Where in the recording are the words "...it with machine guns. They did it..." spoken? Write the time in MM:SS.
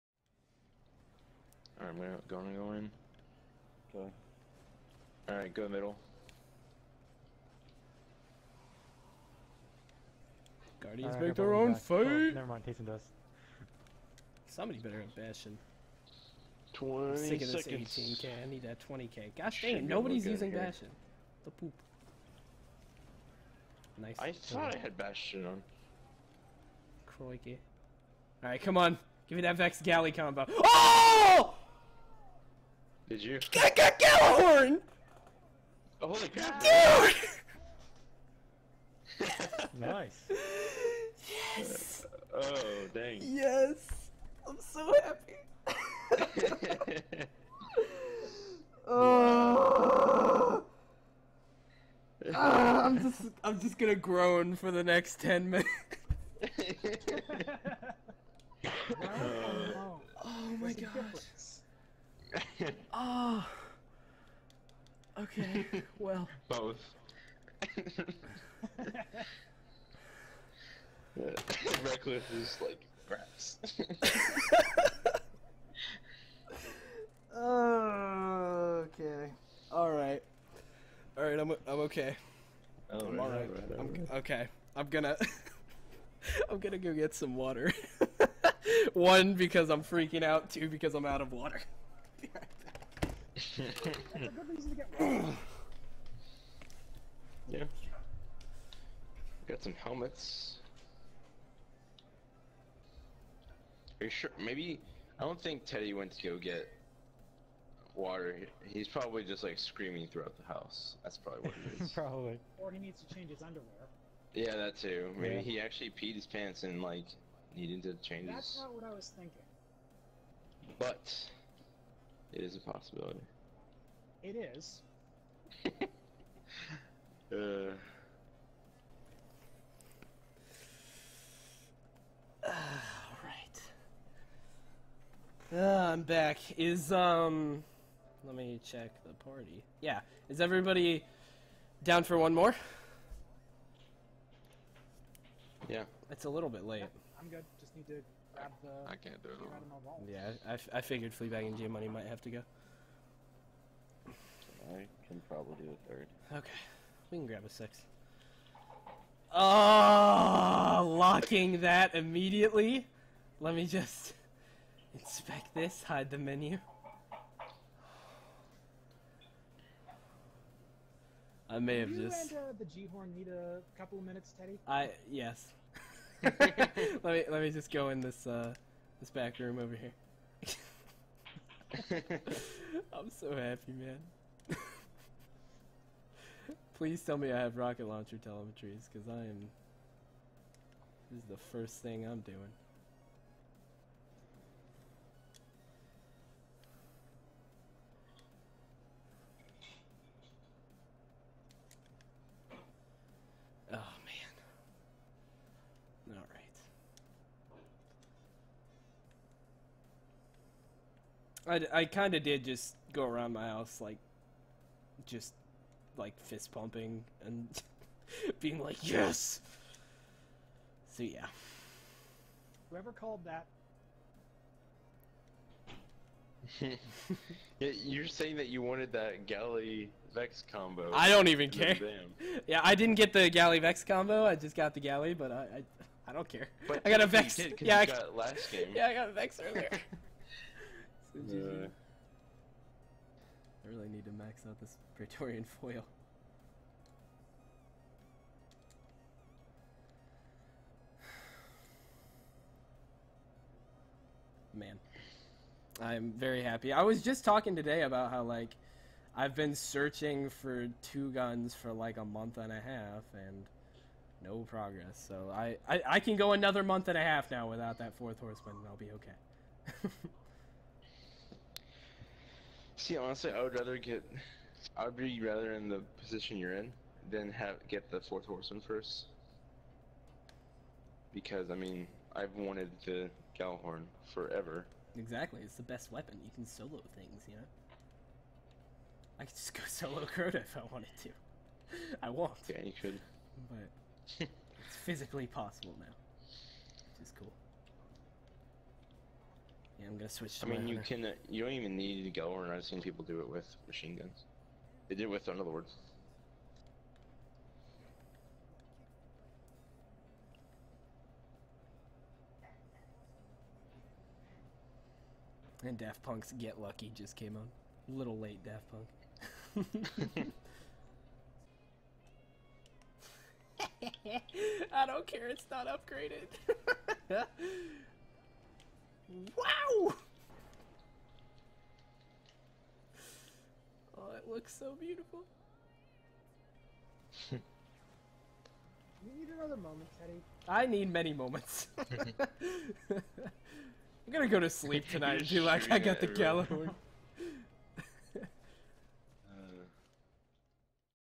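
05:03.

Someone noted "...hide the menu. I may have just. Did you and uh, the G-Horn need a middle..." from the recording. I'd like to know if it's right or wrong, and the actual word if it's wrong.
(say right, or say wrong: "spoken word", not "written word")
wrong: "couple", not "middle".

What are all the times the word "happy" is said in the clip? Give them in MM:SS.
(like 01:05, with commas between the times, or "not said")
00:46, 03:03, 04:16.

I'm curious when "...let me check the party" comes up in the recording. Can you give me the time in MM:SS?
02:18.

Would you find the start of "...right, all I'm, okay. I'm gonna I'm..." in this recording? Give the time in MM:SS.
01:23.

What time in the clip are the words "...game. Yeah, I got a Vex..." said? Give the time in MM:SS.
03:58.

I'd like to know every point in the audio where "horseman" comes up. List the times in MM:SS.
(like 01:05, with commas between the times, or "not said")
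04:28, 04:38.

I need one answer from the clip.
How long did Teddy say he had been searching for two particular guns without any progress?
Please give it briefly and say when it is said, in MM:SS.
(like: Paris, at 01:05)
a month and a half, at 04:21.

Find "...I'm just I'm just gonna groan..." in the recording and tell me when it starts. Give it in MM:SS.
00:52.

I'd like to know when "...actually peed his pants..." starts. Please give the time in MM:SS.
01:55.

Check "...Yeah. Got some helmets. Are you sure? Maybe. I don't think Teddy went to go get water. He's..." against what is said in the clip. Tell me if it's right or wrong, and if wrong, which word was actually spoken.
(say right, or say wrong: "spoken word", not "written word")
right.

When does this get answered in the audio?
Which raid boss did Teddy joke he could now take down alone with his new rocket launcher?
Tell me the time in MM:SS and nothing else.
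04:50.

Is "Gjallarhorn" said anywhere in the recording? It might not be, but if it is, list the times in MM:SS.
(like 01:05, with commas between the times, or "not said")
00:33, 04:43.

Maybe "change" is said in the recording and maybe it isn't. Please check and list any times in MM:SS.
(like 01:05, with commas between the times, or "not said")
01:53, 01:58.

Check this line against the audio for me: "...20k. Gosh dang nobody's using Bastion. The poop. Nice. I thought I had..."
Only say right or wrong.
right.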